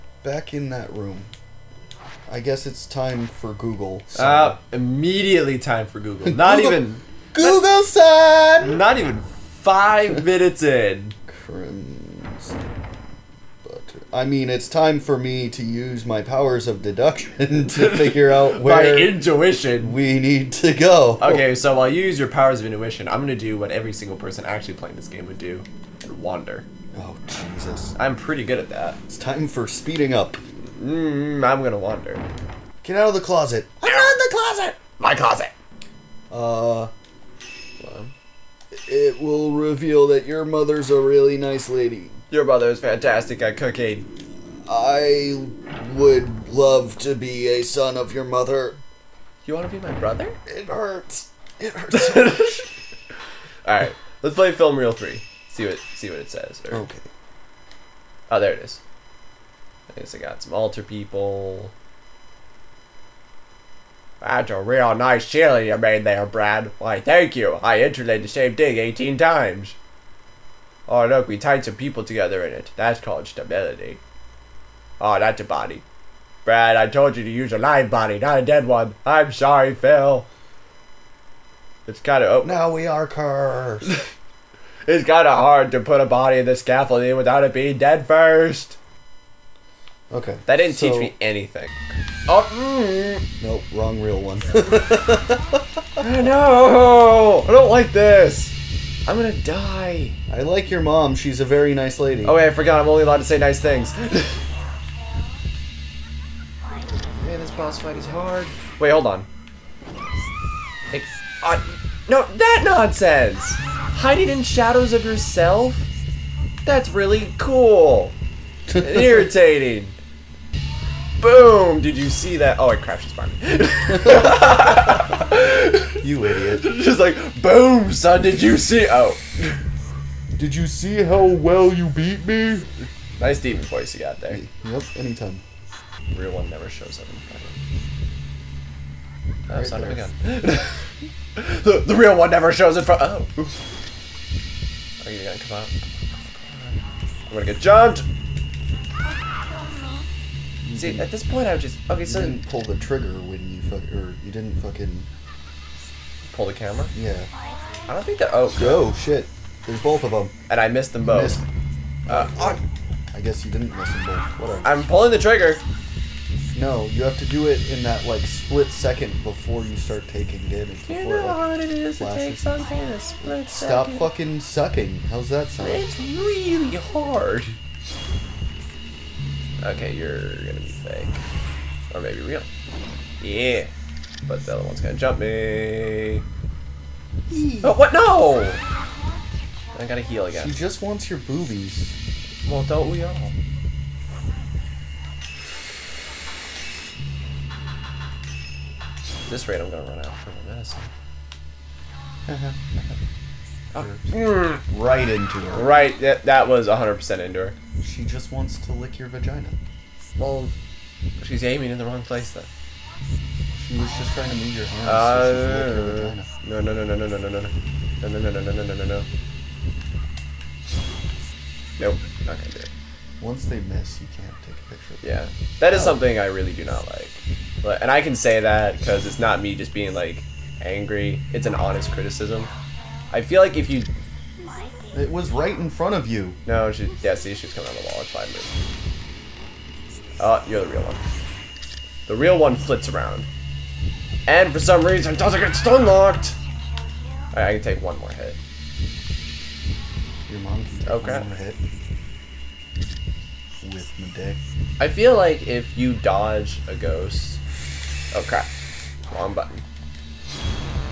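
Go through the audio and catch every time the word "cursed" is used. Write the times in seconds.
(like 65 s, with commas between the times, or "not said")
83 s.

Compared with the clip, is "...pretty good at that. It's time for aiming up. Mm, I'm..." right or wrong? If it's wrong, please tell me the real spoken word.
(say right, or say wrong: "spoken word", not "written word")
wrong: "speeding", not "aiming".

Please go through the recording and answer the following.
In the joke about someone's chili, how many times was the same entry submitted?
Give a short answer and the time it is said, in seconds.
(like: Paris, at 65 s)
18, at 68 s.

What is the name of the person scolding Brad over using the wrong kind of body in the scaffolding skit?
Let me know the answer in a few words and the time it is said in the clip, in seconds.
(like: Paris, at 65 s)
Phil, at 79 s.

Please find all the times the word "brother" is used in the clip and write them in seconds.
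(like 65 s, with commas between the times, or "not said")
42 s, 49 s.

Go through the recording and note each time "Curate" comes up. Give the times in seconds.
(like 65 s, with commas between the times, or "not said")
not said.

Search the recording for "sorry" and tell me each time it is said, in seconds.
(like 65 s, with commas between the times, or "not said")
79 s.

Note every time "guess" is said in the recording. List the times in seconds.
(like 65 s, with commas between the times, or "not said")
2 s, 59 s, 163 s.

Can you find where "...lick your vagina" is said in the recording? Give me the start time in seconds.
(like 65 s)
208 s.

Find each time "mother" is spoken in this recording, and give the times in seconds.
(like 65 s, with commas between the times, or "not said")
40 s, 48 s.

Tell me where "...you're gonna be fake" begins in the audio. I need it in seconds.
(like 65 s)
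179 s.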